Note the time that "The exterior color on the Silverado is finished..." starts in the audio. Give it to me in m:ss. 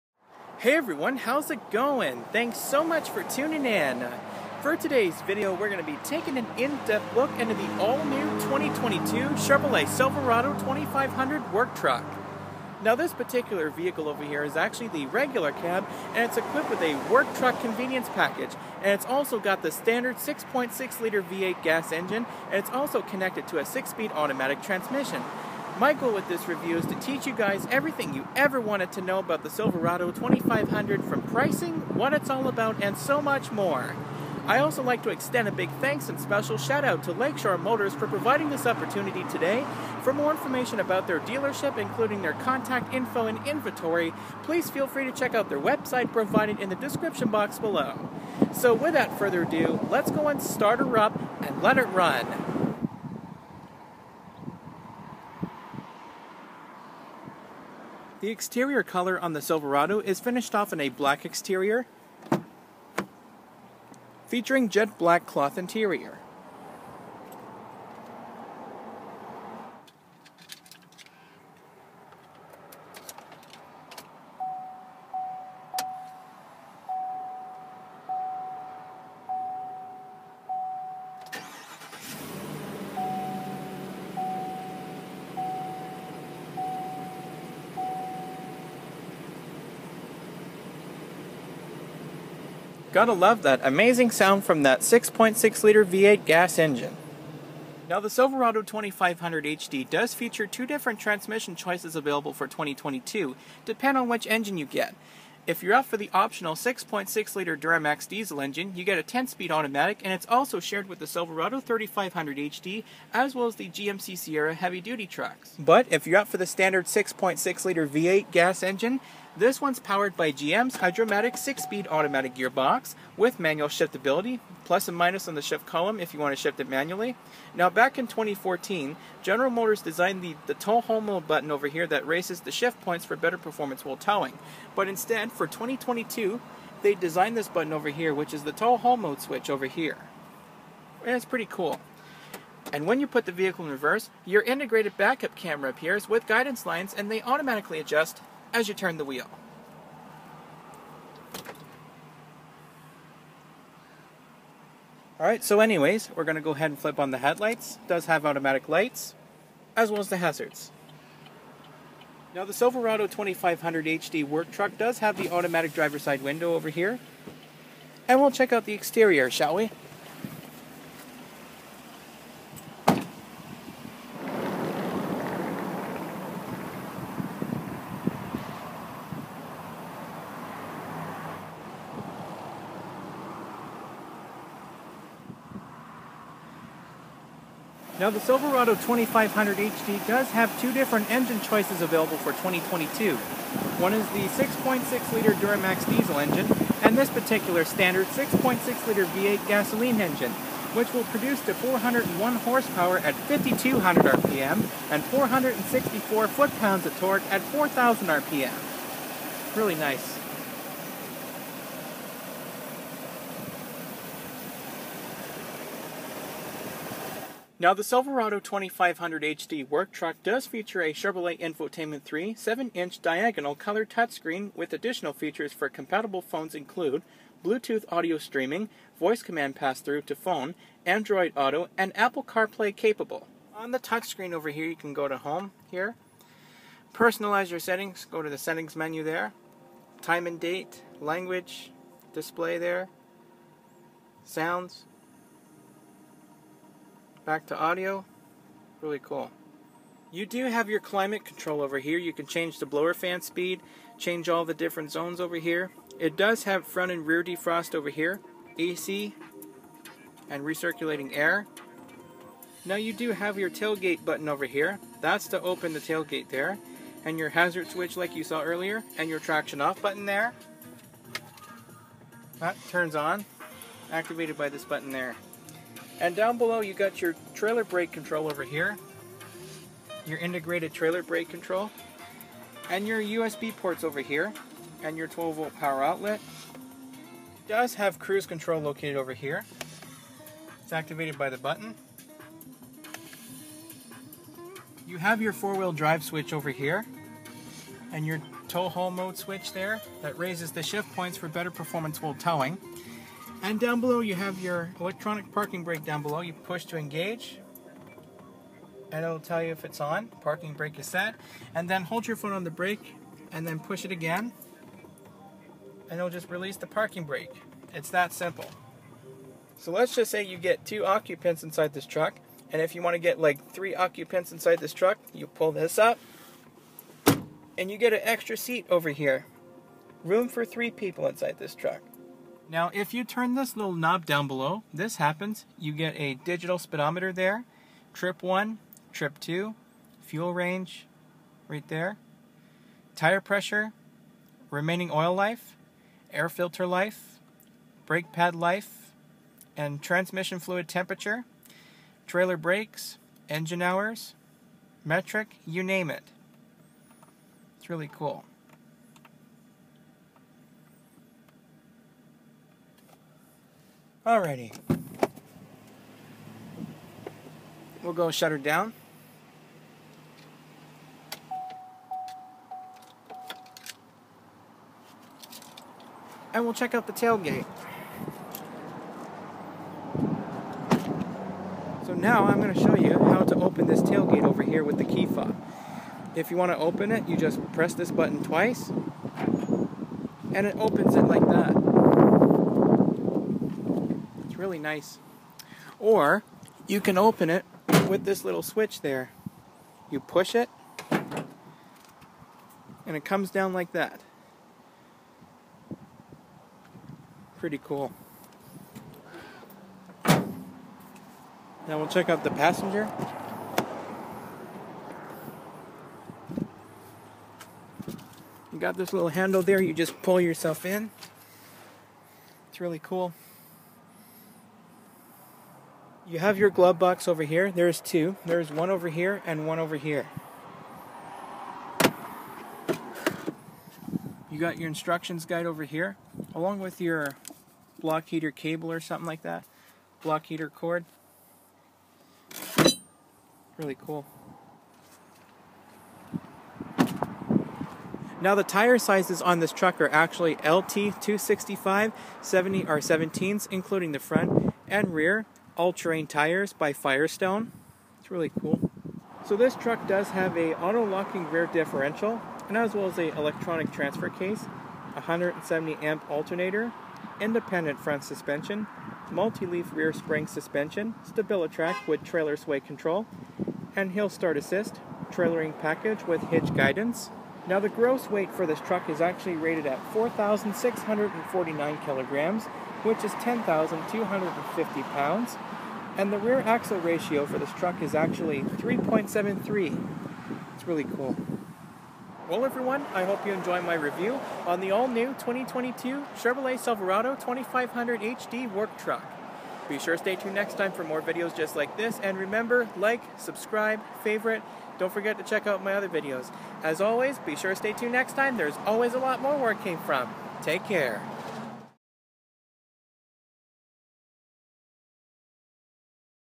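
0:58.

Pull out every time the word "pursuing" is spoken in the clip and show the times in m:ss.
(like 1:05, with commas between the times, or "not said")
not said.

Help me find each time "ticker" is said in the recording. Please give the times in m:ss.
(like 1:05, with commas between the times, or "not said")
not said.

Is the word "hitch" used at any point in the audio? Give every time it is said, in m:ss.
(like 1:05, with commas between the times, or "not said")
7:56.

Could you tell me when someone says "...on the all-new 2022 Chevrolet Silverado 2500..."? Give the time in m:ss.
8:14.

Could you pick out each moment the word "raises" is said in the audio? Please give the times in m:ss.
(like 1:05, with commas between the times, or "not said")
2:12, 5:00.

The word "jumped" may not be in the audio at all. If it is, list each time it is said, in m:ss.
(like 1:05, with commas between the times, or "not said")
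not said.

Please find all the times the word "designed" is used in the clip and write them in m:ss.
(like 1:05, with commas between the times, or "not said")
2:09, 2:16.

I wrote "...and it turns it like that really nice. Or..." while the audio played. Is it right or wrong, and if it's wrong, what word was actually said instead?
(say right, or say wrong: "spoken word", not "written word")
wrong: "opens", not "turns".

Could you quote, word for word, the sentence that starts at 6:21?
So now I'm going to show you how to open this tailgate over here with the key fob.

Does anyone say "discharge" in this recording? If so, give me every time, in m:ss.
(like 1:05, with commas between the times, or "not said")
not said.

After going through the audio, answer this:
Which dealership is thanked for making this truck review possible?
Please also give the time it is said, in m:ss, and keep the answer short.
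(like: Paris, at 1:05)
Lakeshore Motors, at 0:37.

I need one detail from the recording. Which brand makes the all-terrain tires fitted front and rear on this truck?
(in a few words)
Firestone.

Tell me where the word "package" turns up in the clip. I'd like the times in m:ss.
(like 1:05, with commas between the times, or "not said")
0:18, 7:55.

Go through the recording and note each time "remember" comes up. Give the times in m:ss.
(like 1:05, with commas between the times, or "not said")
8:22.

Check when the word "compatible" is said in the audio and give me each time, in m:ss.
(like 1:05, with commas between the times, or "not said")
3:45.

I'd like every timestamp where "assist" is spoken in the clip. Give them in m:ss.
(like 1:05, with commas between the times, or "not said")
7:54.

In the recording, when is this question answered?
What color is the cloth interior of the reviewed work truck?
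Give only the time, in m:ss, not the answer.
1:04.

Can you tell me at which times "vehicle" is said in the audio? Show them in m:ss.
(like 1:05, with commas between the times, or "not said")
0:13, 2:23.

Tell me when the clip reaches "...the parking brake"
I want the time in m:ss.
5:16.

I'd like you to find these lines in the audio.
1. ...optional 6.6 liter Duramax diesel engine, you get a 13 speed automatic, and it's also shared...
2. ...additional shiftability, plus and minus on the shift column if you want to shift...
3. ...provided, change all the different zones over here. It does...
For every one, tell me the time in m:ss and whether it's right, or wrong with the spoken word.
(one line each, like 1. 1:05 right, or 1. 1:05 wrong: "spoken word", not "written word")
1. 1:46 wrong: "10", not "13"
2. 2:03 wrong: "manual", not "additional"
3. 4:13 wrong: "speed", not "provided".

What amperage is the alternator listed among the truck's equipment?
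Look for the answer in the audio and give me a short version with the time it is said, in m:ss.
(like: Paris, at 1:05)
170 amp, at 7:44.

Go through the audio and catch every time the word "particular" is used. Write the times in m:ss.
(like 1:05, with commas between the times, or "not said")
0:13, 3:17.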